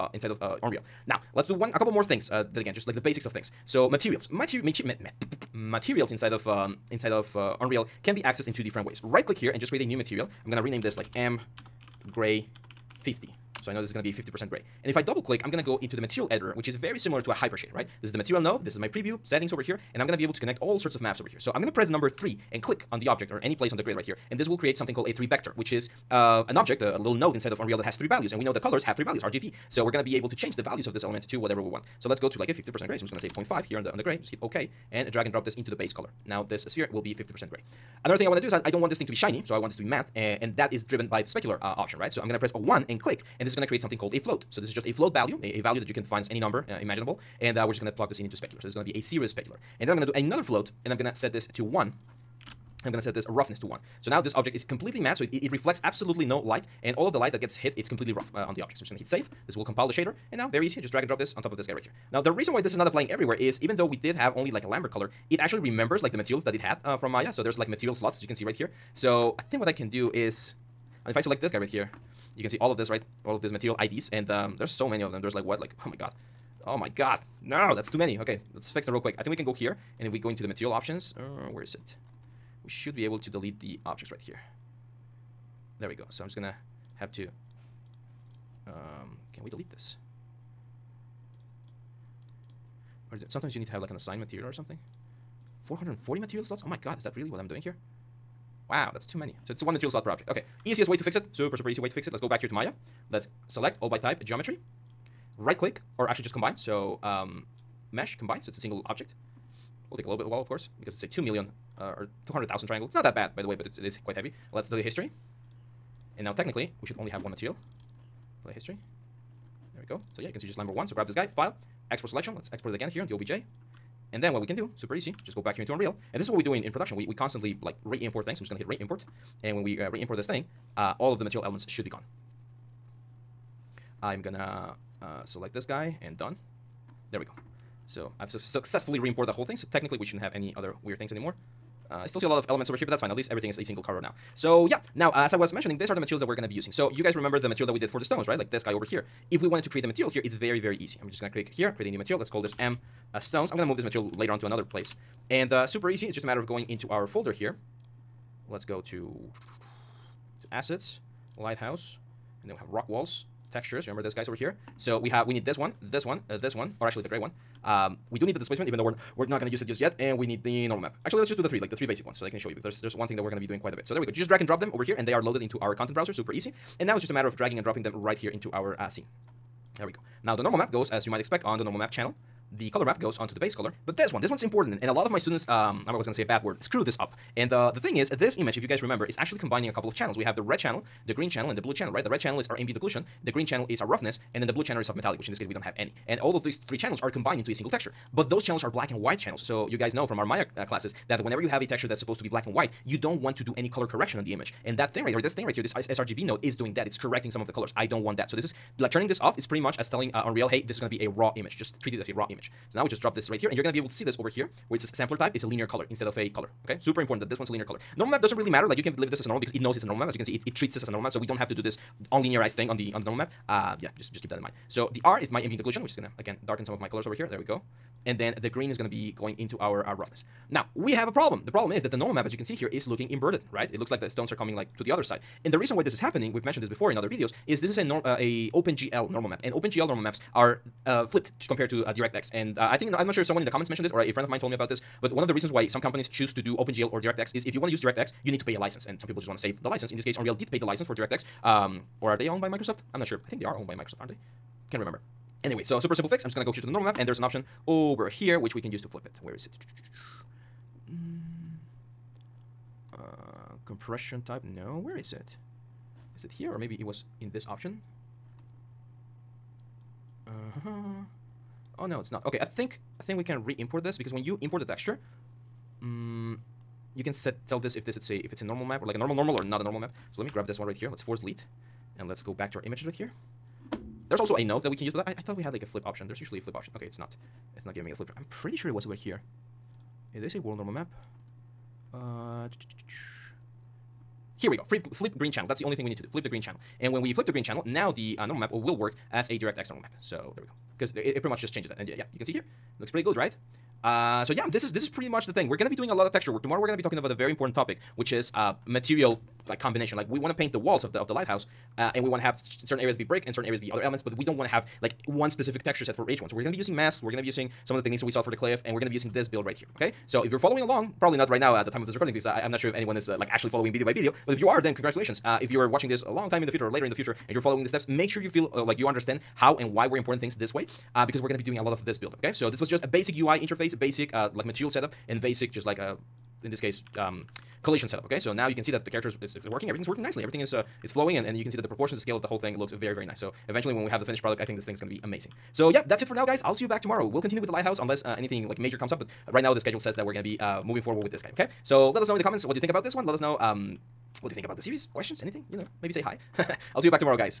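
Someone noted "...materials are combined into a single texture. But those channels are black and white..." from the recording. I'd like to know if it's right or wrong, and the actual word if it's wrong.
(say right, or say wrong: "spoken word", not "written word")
wrong: "channels", not "materials".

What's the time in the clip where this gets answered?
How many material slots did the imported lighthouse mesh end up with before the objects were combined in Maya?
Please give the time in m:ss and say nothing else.
1:35.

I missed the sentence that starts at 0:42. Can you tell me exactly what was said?
So I'm going to press a 1 and click, and this is going to create something called a float.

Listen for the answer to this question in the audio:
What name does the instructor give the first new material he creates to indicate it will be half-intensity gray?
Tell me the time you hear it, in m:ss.
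0:11.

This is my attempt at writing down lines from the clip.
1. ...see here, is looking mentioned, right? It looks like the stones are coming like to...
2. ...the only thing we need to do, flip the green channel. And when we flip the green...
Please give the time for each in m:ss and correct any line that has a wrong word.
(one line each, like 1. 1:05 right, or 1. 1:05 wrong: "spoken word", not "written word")
1. 3:52 wrong: "inverted", not "mentioned"
2. 4:55 right.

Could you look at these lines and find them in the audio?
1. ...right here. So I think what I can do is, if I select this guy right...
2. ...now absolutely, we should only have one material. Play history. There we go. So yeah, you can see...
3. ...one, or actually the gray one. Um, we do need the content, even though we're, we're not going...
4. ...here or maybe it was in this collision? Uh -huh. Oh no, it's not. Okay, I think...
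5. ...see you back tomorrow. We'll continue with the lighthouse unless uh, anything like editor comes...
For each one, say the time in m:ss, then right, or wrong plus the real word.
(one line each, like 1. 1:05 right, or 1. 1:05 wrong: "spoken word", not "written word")
1. 1:08 right
2. 1:56 wrong: "technically", not "absolutely"
3. 2:46 wrong: "displacement", not "content"
4. 4:26 wrong: "option", not "collision"
5. 5:46 wrong: "major", not "editor".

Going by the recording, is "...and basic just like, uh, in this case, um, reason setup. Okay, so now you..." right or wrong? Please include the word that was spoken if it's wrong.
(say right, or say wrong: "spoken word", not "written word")
wrong: "collision", not "reason".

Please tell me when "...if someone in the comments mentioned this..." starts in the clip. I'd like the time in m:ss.
4:03.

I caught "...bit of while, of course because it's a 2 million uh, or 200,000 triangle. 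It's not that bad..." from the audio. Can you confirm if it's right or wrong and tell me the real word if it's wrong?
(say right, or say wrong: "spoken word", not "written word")
right.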